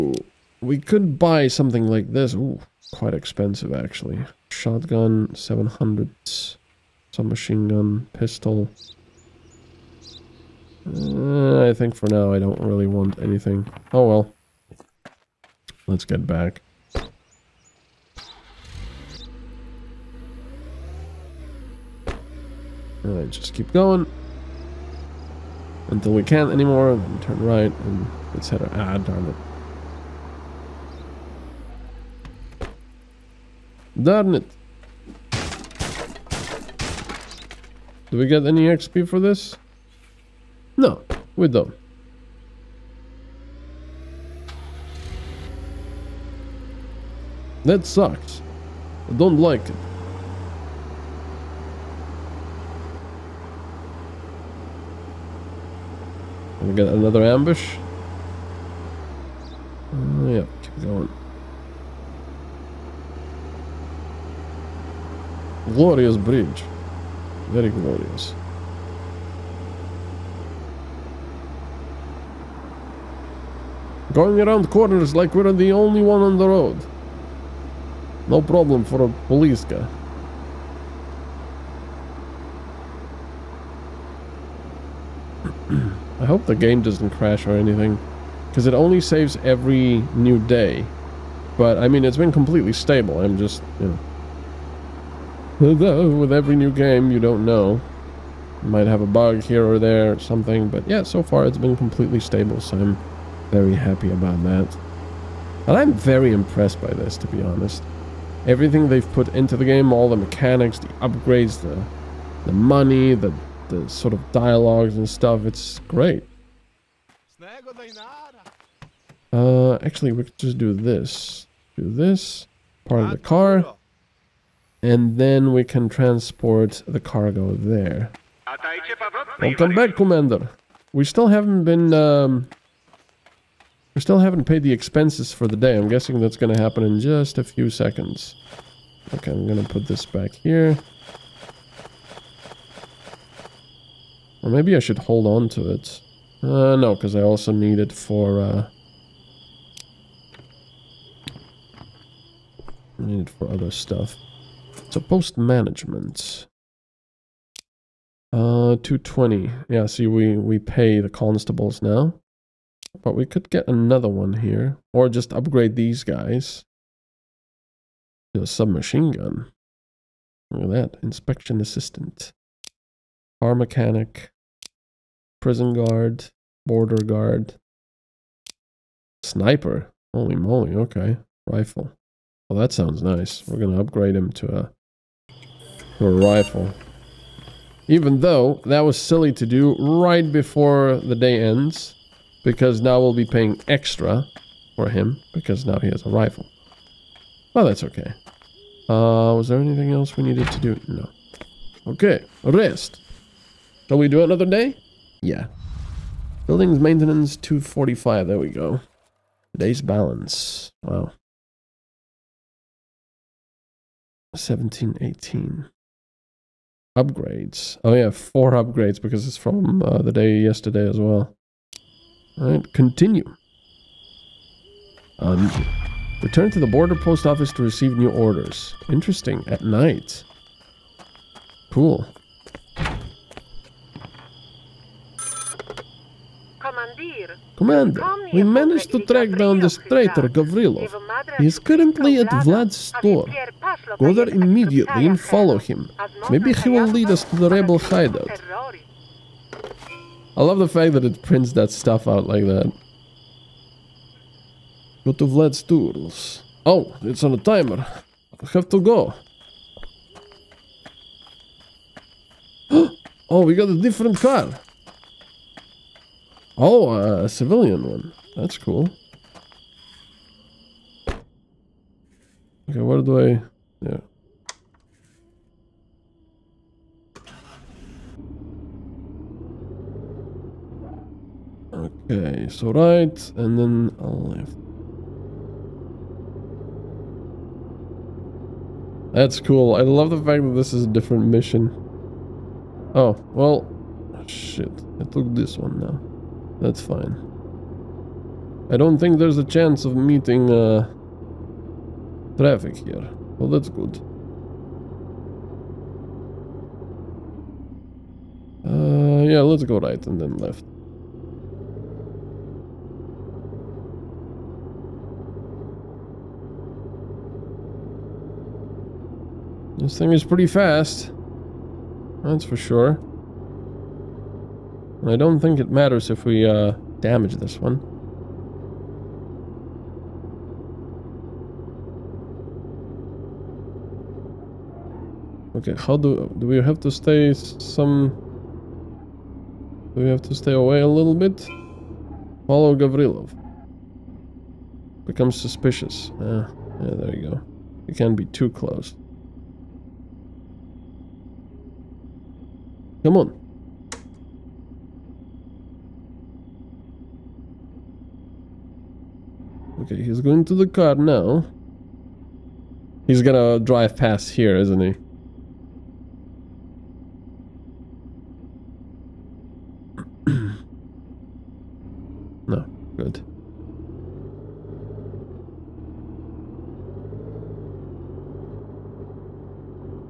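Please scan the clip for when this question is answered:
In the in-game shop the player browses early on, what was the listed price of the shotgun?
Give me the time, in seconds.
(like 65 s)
5 s.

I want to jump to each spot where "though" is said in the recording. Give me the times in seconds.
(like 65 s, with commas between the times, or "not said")
95 s, 188 s.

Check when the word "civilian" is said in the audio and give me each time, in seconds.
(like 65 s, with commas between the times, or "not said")
267 s.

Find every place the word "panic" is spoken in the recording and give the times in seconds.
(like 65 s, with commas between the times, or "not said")
not said.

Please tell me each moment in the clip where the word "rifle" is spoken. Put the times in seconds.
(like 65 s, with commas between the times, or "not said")
181 s, 186 s, 196 s.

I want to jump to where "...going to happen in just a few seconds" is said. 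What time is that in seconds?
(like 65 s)
136 s.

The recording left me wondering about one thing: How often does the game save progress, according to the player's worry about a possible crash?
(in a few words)
Every new day.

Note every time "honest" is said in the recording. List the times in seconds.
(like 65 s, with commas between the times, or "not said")
107 s.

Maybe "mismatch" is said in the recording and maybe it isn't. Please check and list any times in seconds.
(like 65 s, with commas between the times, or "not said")
not said.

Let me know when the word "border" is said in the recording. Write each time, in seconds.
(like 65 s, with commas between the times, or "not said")
176 s, 226 s.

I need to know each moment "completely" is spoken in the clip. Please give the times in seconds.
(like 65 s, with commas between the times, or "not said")
92 s, 101 s.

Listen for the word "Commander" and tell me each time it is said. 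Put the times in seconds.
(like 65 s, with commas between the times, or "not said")
129 s, 237 s.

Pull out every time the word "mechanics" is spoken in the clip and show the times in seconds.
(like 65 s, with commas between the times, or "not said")
110 s, 173 s.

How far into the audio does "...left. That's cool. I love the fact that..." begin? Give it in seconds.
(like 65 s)
284 s.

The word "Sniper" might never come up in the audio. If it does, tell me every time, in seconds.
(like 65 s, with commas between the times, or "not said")
179 s.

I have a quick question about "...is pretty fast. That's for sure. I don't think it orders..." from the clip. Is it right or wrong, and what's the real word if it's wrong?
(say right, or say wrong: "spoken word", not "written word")
wrong: "matters", not "orders".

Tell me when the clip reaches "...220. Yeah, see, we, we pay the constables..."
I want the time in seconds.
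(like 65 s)
158 s.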